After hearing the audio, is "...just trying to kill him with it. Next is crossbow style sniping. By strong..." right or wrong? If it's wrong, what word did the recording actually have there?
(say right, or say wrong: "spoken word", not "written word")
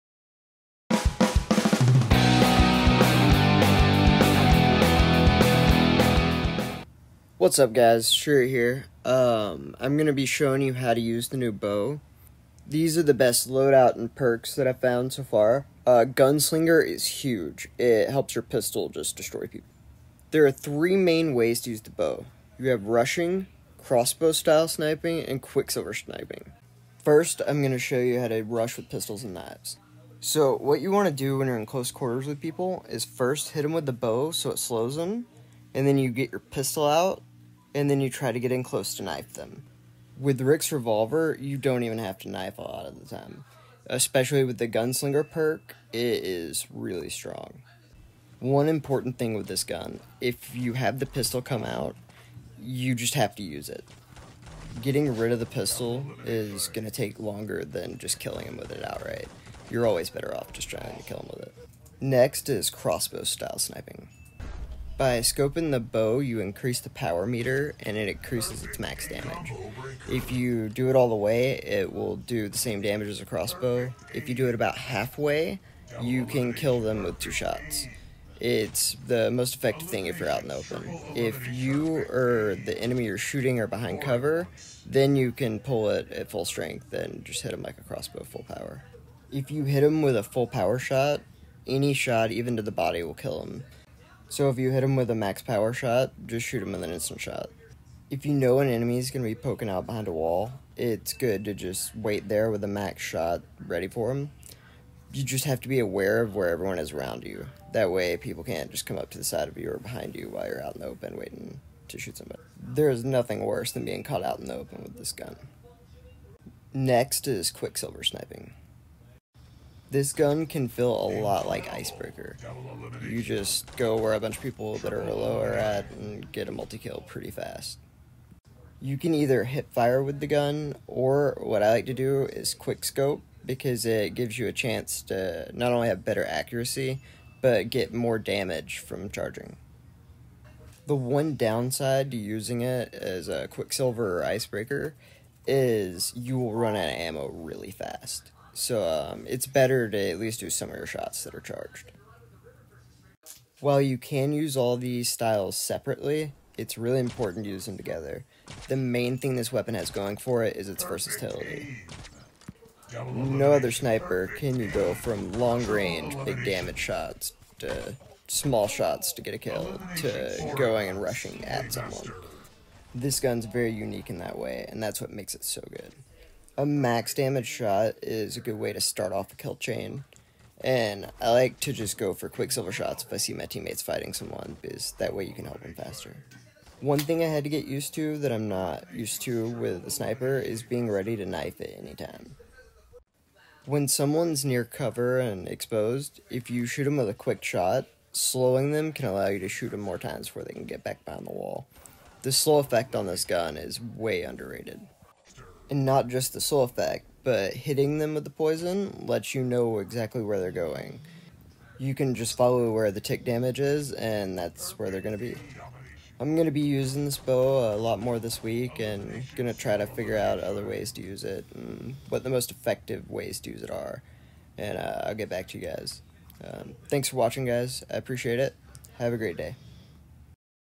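wrong: "scoping", not "strong".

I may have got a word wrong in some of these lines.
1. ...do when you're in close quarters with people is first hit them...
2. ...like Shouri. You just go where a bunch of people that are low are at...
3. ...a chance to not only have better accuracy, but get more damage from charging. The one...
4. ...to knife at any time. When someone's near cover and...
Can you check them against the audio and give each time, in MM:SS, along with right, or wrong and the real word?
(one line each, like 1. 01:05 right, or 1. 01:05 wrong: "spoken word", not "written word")
1. 00:31 right
2. 02:01 wrong: "Icebreaker", not "Shouri"
3. 02:14 right
4. 03:11 right.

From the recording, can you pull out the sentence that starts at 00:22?
You have rushing, crossbow style sniping, and quicksilver sniping.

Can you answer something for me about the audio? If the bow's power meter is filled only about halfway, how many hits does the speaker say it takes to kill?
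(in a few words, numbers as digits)
2.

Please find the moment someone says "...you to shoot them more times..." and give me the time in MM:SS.
03:19.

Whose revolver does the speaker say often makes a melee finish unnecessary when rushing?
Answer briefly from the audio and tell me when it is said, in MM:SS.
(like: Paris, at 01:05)
Rick, at 00:40.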